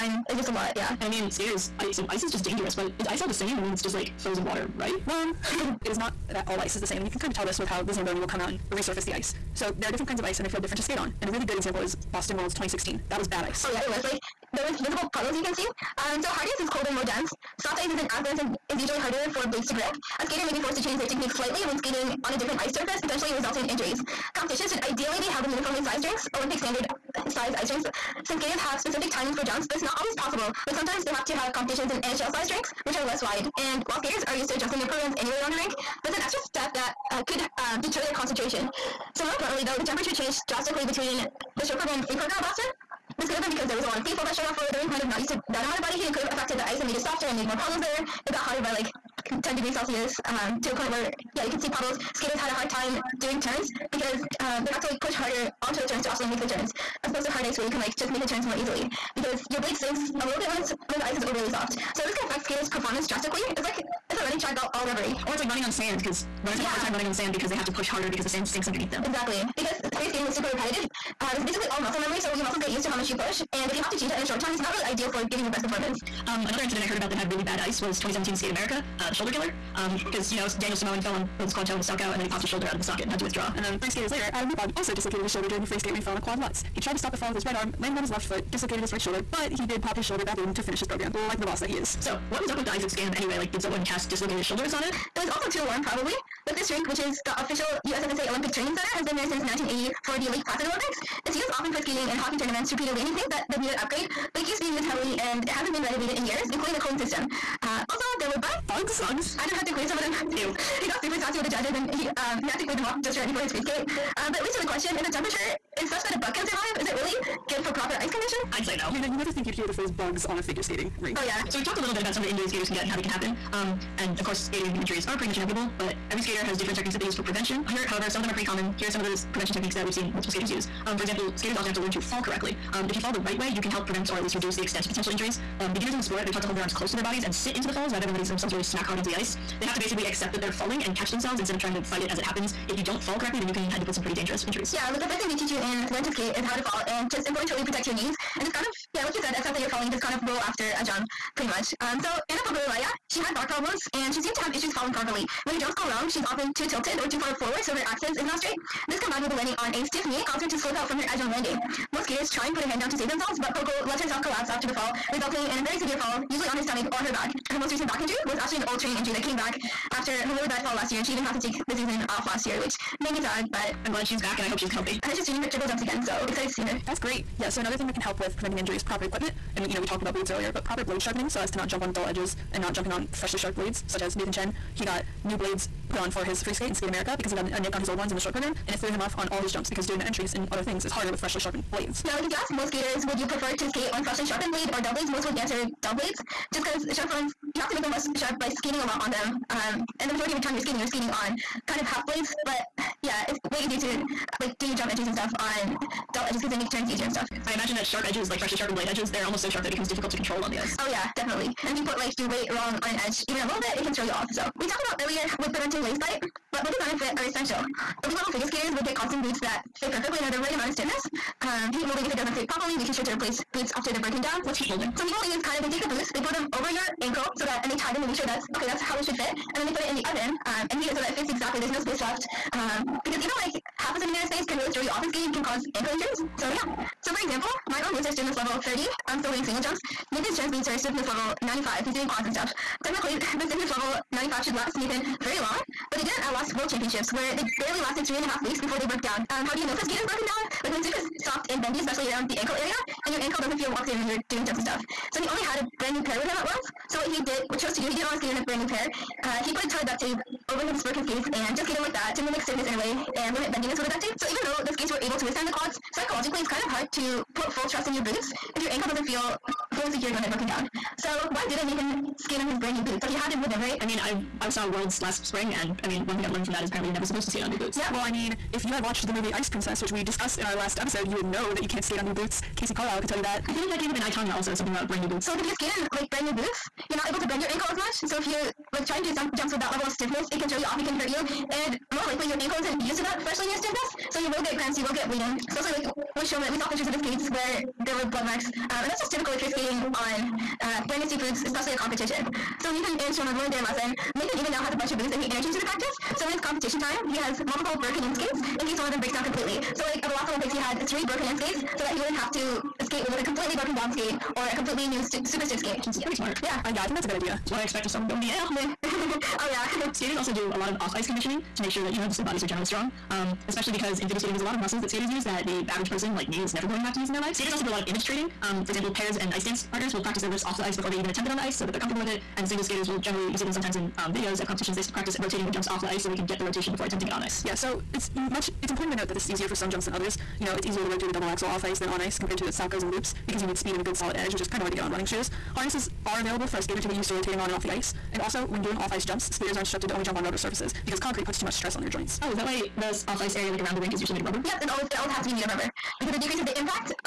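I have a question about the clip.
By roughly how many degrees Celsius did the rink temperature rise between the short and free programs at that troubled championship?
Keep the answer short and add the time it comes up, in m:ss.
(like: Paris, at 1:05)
10, at 0:49.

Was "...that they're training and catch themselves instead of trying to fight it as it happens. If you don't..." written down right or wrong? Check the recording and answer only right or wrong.
wrong.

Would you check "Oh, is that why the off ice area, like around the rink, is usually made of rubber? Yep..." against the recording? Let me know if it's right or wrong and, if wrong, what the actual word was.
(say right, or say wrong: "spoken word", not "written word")
right.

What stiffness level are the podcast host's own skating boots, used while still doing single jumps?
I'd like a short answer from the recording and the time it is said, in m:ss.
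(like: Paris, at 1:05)
30, at 3:58.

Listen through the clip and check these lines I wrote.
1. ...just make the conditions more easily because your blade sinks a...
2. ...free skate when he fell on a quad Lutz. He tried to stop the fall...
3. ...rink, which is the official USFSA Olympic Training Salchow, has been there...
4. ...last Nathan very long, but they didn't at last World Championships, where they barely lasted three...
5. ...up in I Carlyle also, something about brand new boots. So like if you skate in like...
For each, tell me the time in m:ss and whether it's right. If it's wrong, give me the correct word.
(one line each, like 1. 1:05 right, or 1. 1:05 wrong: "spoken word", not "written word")
1. 0:57 wrong: "turns", not "conditions"
2. 1:25 right
3. 1:36 wrong: "Center", not "Salchow"
4. 4:04 right
5. 4:43 wrong: "Tonya", not "Carlyle".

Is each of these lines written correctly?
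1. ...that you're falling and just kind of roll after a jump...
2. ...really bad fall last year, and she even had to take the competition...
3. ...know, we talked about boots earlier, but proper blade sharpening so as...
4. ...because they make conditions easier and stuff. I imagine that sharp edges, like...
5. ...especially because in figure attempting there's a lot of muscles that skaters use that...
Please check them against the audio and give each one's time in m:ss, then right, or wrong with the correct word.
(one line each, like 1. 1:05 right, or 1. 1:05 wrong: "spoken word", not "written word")
1. 2:29 right
2. 2:50 wrong: "season", not "competition"
3. 2:59 right
4. 3:26 wrong: "turns", not "conditions"
5. 5:23 wrong: "skating", not "attempting".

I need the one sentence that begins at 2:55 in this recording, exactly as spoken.
I heard she's training her triple jumps again, so excited to see her.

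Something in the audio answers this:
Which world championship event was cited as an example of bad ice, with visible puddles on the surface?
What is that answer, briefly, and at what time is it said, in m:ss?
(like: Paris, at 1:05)
Boston Worlds 2016, at 0:12.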